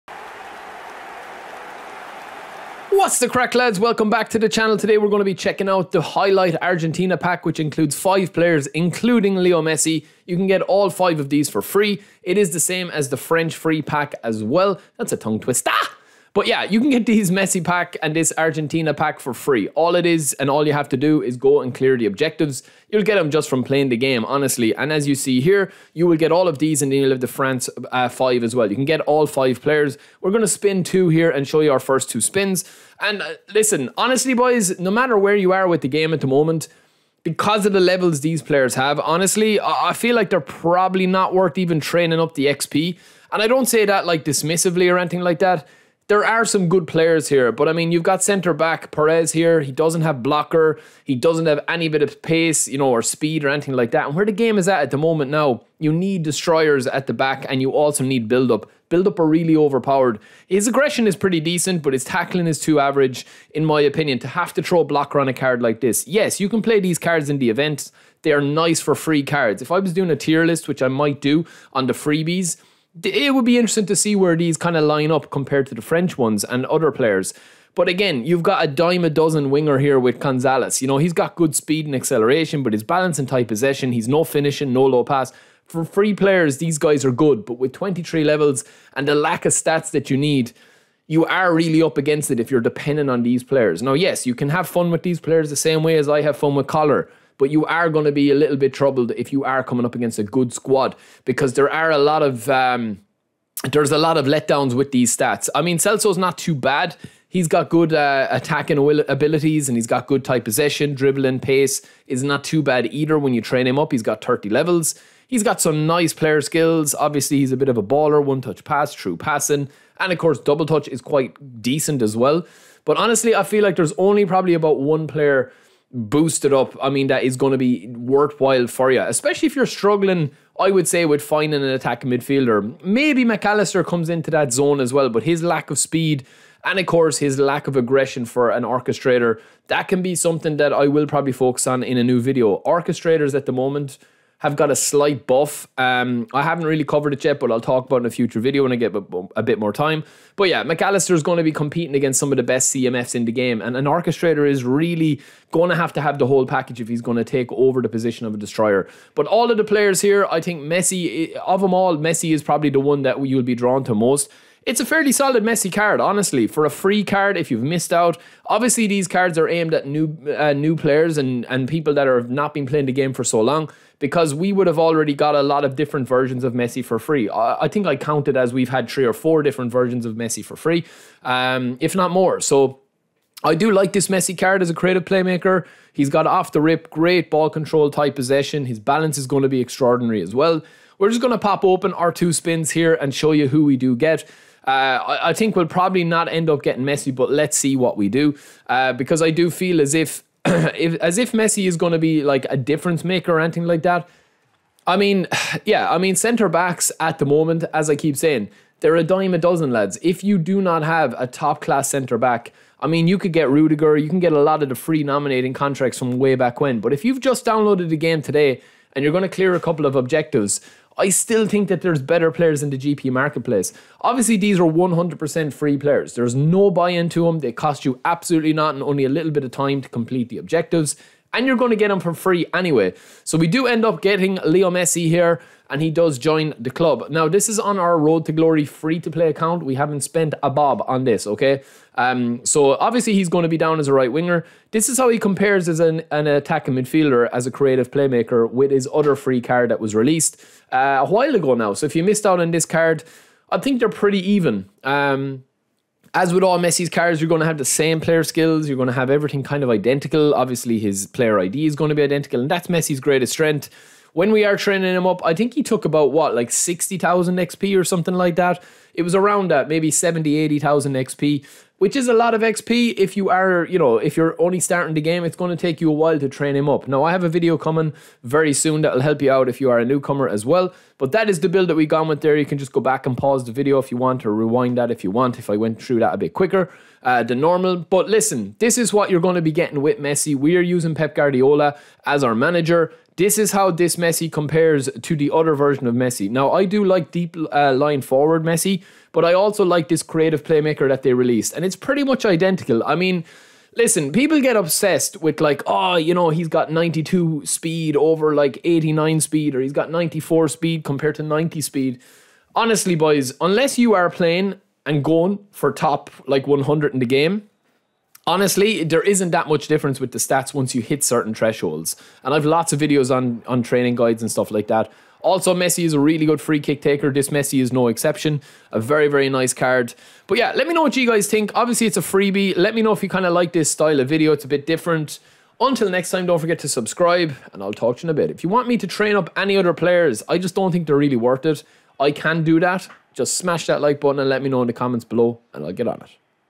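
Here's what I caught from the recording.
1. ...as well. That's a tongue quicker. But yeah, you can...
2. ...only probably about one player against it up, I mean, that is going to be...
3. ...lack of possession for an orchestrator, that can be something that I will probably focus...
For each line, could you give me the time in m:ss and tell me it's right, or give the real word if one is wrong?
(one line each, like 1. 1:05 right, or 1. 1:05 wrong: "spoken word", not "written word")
1. 0:14 wrong: "twister", not "quicker"
2. 2:03 wrong: "boost", not "against"
3. 2:17 wrong: "aggression", not "possession".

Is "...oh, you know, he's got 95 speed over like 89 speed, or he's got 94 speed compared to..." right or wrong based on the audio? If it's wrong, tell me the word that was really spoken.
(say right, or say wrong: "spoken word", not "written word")
wrong: "92", not "95".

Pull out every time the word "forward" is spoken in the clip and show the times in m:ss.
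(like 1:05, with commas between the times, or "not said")
4:58.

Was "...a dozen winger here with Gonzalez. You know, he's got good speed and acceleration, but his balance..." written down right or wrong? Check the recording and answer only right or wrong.
right.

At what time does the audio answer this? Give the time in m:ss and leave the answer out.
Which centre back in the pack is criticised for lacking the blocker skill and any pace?
0:48.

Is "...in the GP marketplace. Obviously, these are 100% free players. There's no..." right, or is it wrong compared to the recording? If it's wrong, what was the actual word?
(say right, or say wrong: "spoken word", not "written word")
right.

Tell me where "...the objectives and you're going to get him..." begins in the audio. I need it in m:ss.
3:50.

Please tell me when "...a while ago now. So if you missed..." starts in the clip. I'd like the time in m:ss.
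4:10.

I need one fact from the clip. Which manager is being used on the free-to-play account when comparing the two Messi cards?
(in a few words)
Pep Guardiola.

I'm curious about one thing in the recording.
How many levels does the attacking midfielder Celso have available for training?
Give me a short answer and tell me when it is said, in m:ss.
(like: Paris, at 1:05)
30, at 1:54.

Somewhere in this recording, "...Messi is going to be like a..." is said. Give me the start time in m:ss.
3:21.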